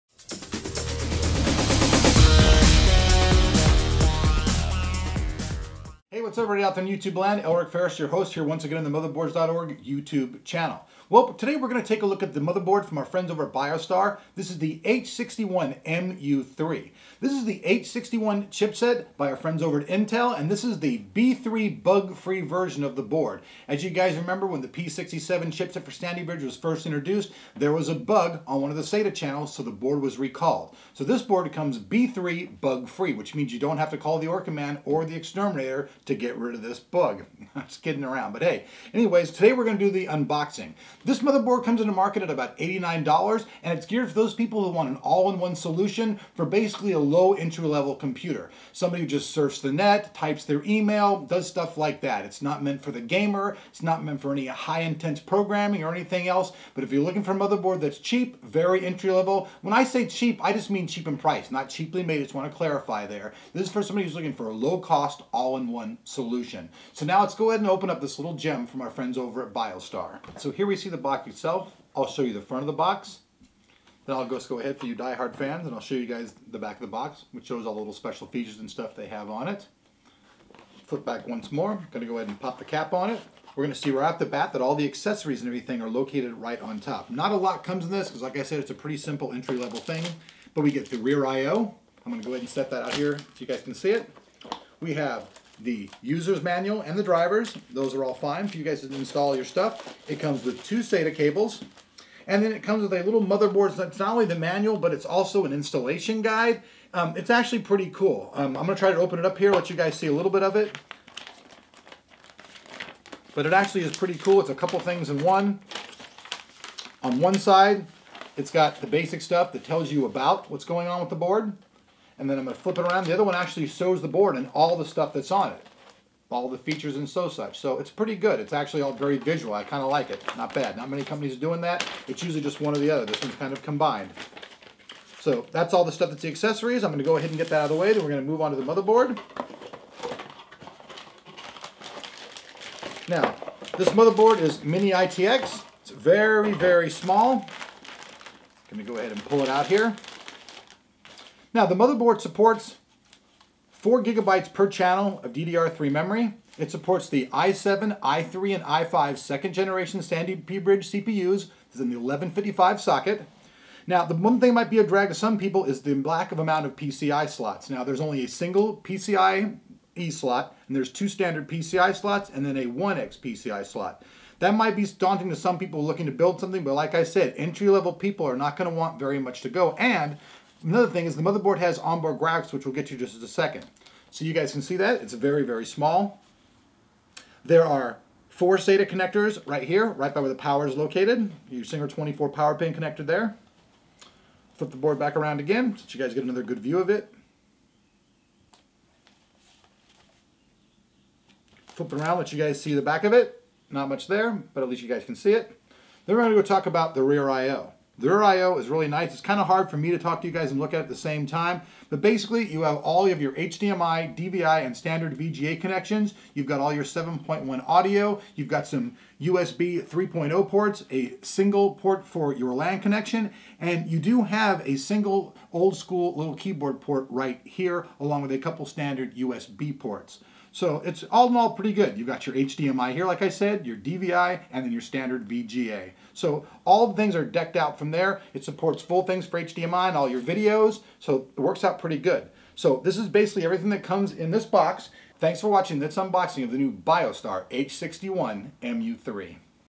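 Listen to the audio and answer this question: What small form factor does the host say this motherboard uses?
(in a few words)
mini ITX.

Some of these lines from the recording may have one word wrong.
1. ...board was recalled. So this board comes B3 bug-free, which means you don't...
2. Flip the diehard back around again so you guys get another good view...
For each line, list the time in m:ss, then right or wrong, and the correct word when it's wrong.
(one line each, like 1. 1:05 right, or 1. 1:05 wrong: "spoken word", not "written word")
1. 0:29 right
2. 3:14 wrong: "board", not "diehard".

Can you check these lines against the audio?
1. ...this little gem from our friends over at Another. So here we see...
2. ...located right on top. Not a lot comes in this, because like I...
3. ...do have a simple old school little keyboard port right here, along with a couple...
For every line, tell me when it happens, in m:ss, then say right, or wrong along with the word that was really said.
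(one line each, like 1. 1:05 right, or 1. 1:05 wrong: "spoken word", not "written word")
1. 1:08 wrong: "Biostar", not "Another"
2. 1:25 right
3. 3:43 wrong: "single", not "simple".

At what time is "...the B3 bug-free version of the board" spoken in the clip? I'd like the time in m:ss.
0:20.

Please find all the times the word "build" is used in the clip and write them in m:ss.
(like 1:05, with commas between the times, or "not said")
2:56.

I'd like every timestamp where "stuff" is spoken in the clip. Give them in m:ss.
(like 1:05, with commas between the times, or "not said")
0:51, 1:18, 1:39, 1:59, 2:04, 2:15.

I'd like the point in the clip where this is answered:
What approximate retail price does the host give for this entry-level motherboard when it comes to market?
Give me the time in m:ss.
0:42.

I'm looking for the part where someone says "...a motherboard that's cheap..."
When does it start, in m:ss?
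0:57.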